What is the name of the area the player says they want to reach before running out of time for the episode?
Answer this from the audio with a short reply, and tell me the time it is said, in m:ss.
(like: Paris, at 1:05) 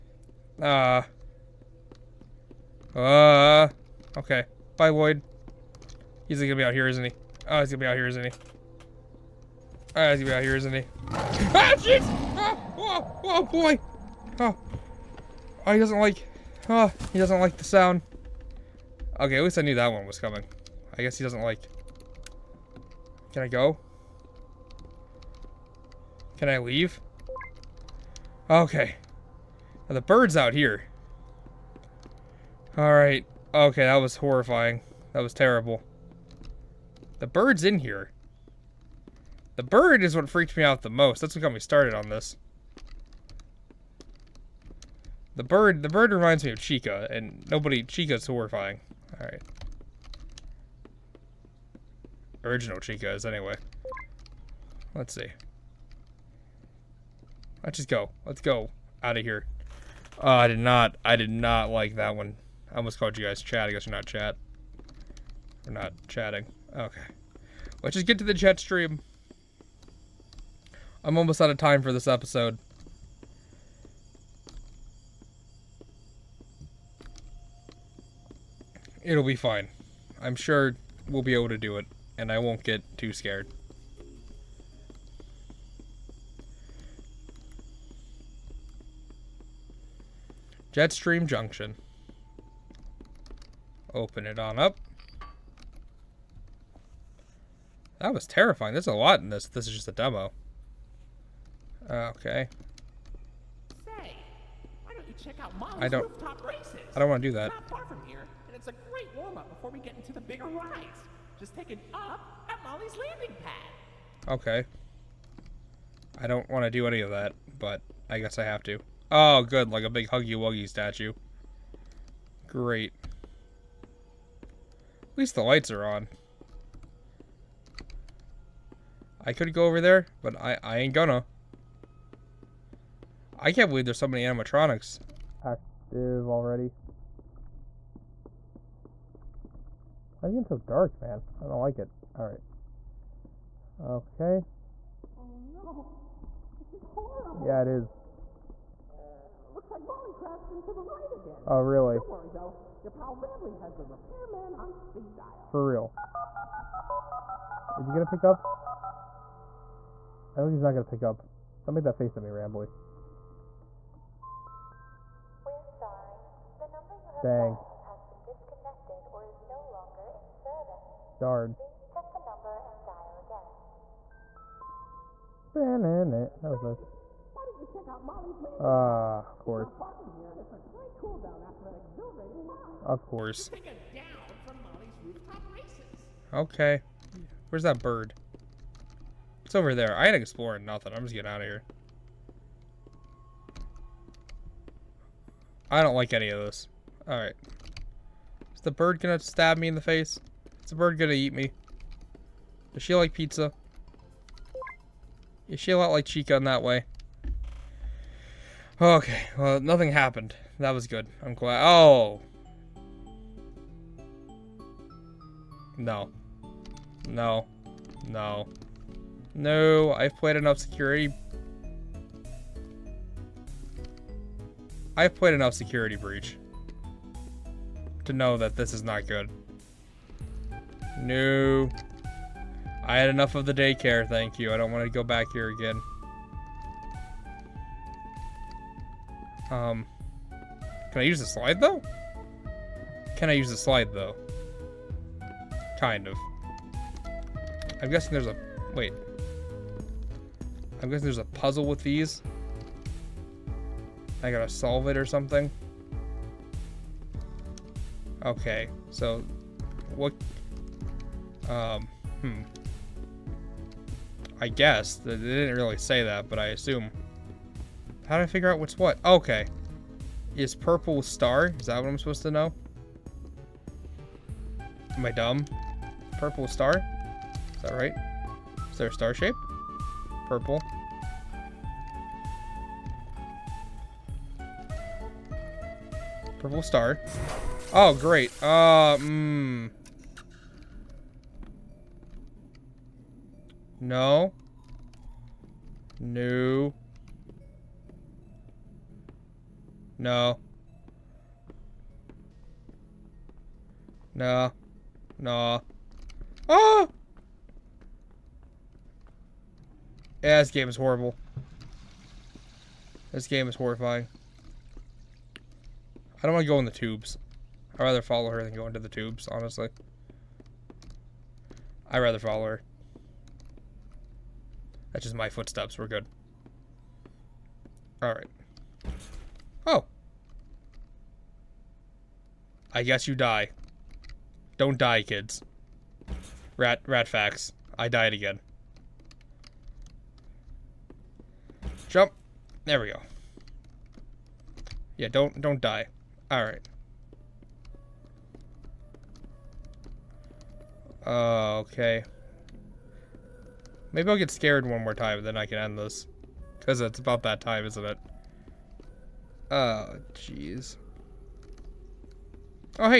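Jetstream Junction, at 1:30.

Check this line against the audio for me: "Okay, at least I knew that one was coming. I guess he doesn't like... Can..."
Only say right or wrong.
right.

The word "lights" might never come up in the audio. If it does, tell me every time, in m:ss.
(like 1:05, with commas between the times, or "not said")
2:05.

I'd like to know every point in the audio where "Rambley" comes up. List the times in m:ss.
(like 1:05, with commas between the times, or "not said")
2:33, 2:42.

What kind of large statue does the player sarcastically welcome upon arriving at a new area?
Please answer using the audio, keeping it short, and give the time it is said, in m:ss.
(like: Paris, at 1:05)
Huggy Wuggy statue, at 2:00.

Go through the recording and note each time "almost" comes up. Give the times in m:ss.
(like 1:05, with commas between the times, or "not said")
1:02, 1:11.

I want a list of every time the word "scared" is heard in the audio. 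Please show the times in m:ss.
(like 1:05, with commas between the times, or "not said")
1:23, 5:54.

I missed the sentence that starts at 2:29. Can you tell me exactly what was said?
Looks like Molly crashed into the right again.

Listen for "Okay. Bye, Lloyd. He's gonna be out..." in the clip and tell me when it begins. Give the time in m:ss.
0:04.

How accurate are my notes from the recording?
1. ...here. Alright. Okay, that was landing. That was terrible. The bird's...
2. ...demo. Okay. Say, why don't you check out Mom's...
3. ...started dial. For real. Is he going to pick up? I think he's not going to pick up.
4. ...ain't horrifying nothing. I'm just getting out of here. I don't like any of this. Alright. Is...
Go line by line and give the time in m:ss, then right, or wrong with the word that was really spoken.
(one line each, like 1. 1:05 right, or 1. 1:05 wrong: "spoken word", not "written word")
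1. 0:30 wrong: "horrifying", not "landing"
2. 1:39 right
3. 2:34 wrong: "speed", not "started"
4. 3:10 wrong: "exploring", not "horrifying".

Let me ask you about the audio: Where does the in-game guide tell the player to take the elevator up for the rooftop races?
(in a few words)
Molly's landing pad.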